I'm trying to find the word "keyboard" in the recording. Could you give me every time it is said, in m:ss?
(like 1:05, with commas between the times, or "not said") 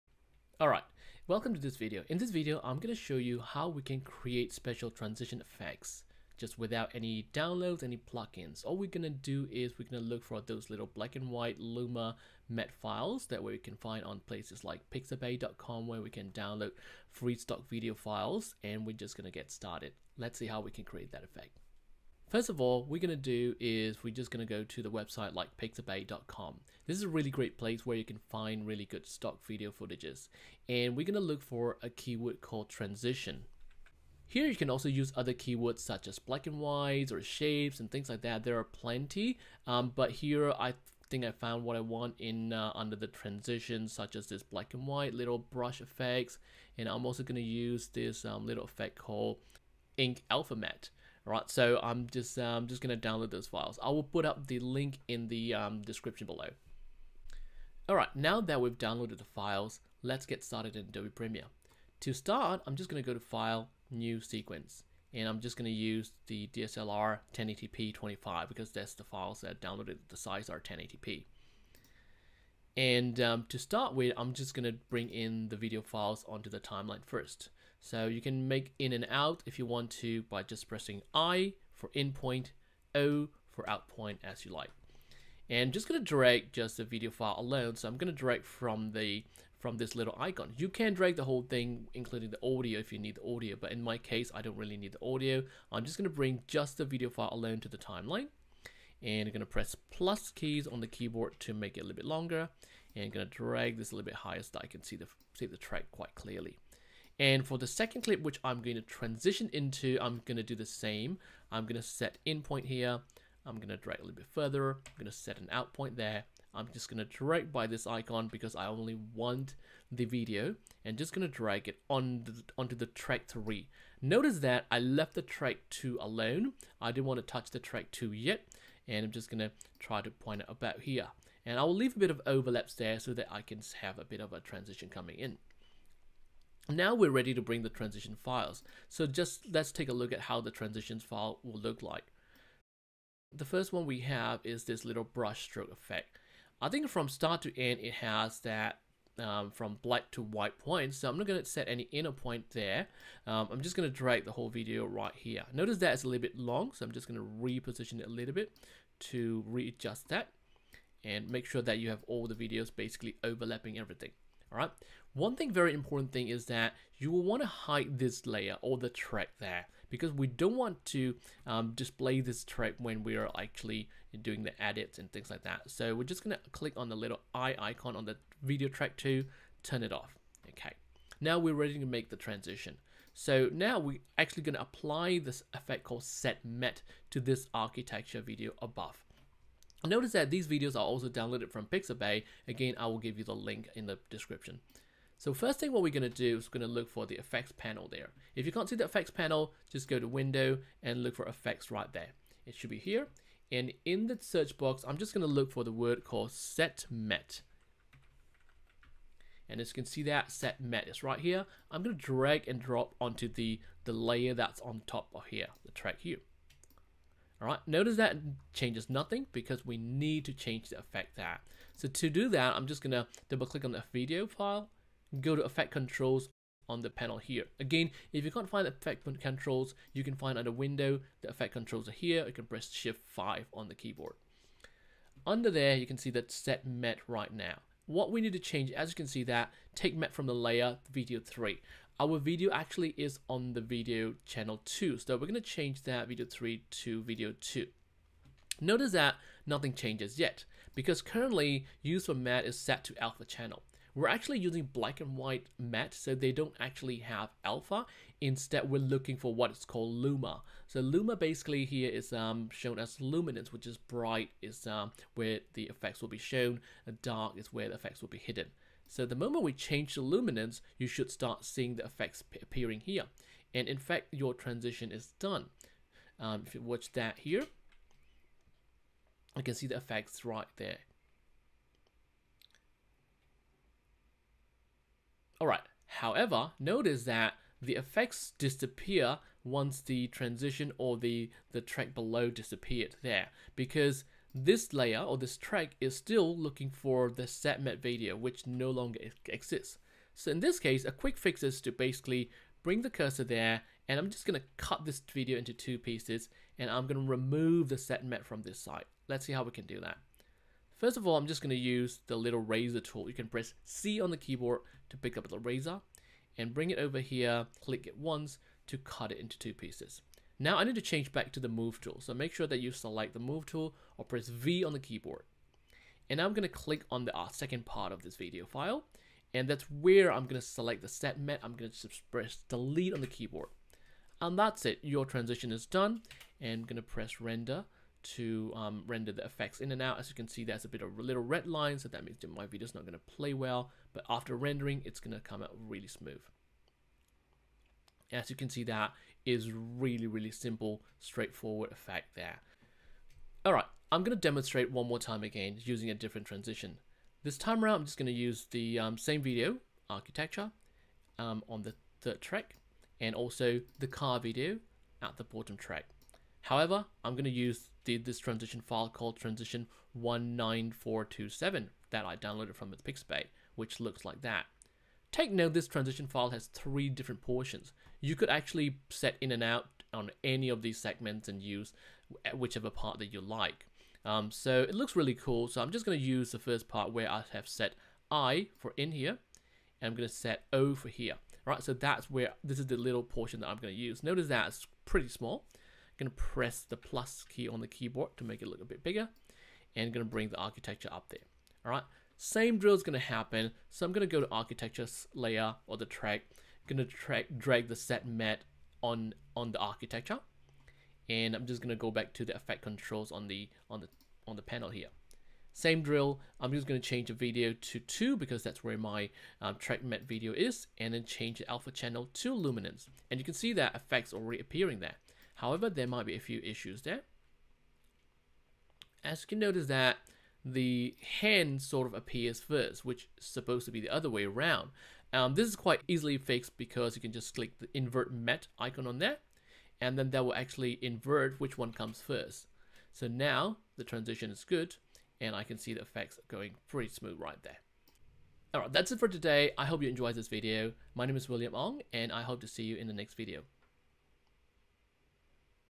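1:40, 3:53, 5:14, 5:24, 5:33, 6:37.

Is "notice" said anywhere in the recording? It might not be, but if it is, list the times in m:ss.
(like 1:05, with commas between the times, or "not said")
2:04, 2:35, 3:09, 3:37, 4:08, 4:46, 6:34, 7:09.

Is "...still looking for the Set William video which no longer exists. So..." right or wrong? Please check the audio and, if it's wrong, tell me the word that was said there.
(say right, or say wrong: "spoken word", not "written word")
wrong: "Matte", not "William".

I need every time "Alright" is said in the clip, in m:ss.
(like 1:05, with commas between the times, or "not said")
0:00, 0:51, 0:57, 4:45, 7:28.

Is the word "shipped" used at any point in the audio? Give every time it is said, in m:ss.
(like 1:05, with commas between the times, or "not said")
not said.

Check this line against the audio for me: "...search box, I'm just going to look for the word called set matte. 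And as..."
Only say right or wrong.
right.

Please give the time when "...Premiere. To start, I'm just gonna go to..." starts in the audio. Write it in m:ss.
1:01.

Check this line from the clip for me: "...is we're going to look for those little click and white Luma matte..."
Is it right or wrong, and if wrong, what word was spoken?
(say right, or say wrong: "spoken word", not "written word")
wrong: "black", not "click".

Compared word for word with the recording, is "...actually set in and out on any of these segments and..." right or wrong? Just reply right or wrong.
right.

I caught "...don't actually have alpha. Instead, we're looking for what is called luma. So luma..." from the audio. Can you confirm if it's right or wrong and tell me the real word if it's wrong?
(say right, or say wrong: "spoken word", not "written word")
right.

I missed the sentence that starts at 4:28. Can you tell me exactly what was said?
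So the moment we change the luminance, you should start seeing the effects appearing here.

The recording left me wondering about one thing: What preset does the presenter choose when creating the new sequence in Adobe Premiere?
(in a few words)
DSLR 1080p 25.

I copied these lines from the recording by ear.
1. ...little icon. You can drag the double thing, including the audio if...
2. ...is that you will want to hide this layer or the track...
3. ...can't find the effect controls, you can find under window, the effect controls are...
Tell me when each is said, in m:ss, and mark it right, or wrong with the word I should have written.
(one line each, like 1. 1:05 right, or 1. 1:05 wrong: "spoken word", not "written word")
1. 1:29 wrong: "whole", not "double"
2. 2:46 right
3. 3:48 right.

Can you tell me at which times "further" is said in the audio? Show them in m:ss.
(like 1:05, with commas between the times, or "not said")
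1:54.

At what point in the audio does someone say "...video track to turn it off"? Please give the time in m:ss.
2:58.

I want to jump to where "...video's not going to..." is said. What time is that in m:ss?
5:42.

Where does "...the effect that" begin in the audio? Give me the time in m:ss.
3:40.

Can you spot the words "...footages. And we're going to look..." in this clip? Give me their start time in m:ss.
0:29.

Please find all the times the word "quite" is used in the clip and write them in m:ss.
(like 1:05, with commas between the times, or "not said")
1:45, 7:15.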